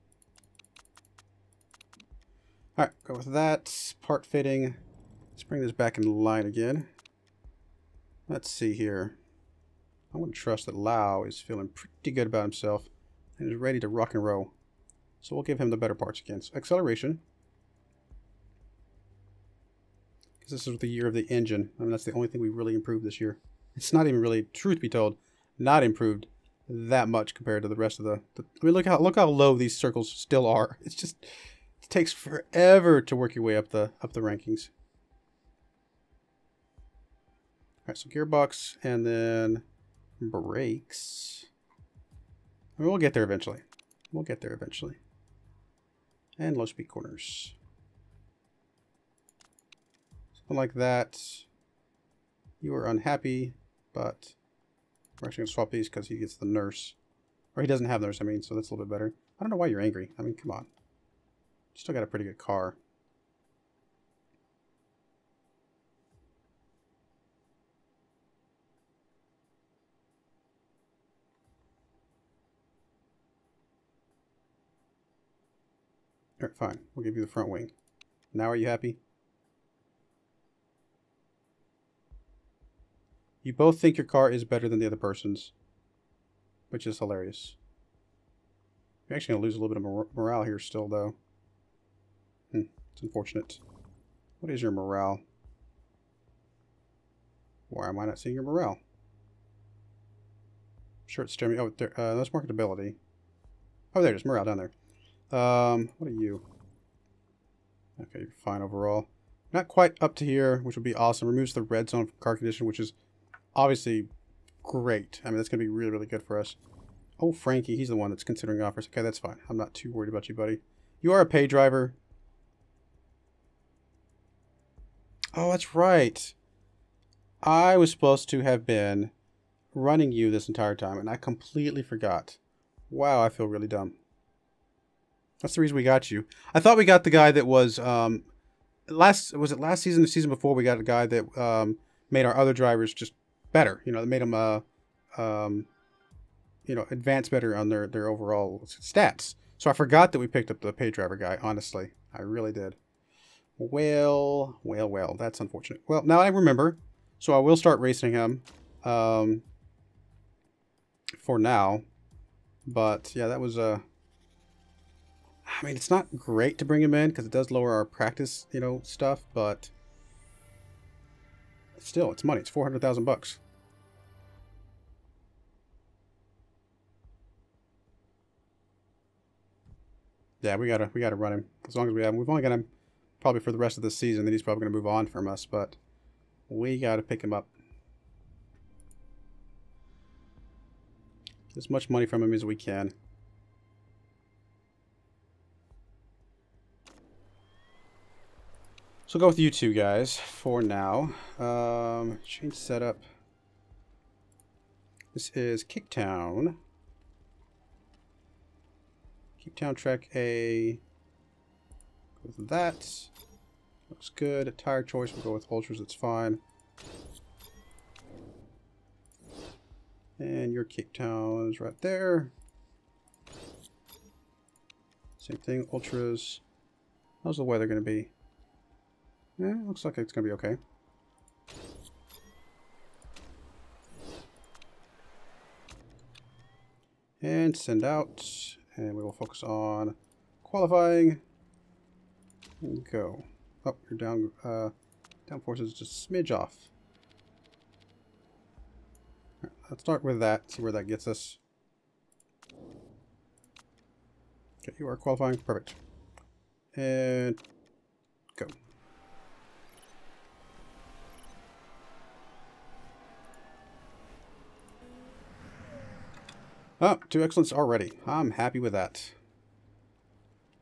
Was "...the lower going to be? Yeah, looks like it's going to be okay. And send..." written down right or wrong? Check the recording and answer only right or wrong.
wrong.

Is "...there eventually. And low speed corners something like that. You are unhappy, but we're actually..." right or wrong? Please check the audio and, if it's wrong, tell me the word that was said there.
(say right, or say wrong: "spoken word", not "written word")
right.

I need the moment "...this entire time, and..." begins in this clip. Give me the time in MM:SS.
02:10.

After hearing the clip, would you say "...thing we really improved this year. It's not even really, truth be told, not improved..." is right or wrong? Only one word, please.
right.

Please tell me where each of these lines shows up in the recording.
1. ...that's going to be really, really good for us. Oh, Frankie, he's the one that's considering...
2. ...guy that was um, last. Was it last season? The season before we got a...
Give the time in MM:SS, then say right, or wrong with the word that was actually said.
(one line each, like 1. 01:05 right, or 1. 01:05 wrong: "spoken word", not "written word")
1. 01:55 right
2. 02:17 right.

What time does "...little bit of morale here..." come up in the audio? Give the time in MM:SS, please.
01:29.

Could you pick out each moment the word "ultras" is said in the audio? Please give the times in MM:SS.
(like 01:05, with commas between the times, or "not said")
03:35, 03:45.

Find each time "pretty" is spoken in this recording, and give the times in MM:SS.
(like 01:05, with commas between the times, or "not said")
00:11, 01:02.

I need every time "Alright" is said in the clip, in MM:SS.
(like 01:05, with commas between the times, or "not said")
00:02.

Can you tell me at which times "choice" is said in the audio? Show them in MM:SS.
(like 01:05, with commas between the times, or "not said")
03:34.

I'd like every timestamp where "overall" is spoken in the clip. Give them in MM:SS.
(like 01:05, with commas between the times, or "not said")
01:48, 02:28.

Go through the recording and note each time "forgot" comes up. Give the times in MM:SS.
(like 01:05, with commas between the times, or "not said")
02:11, 02:29.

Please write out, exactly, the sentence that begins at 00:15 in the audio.
So we'll give him the better parts again.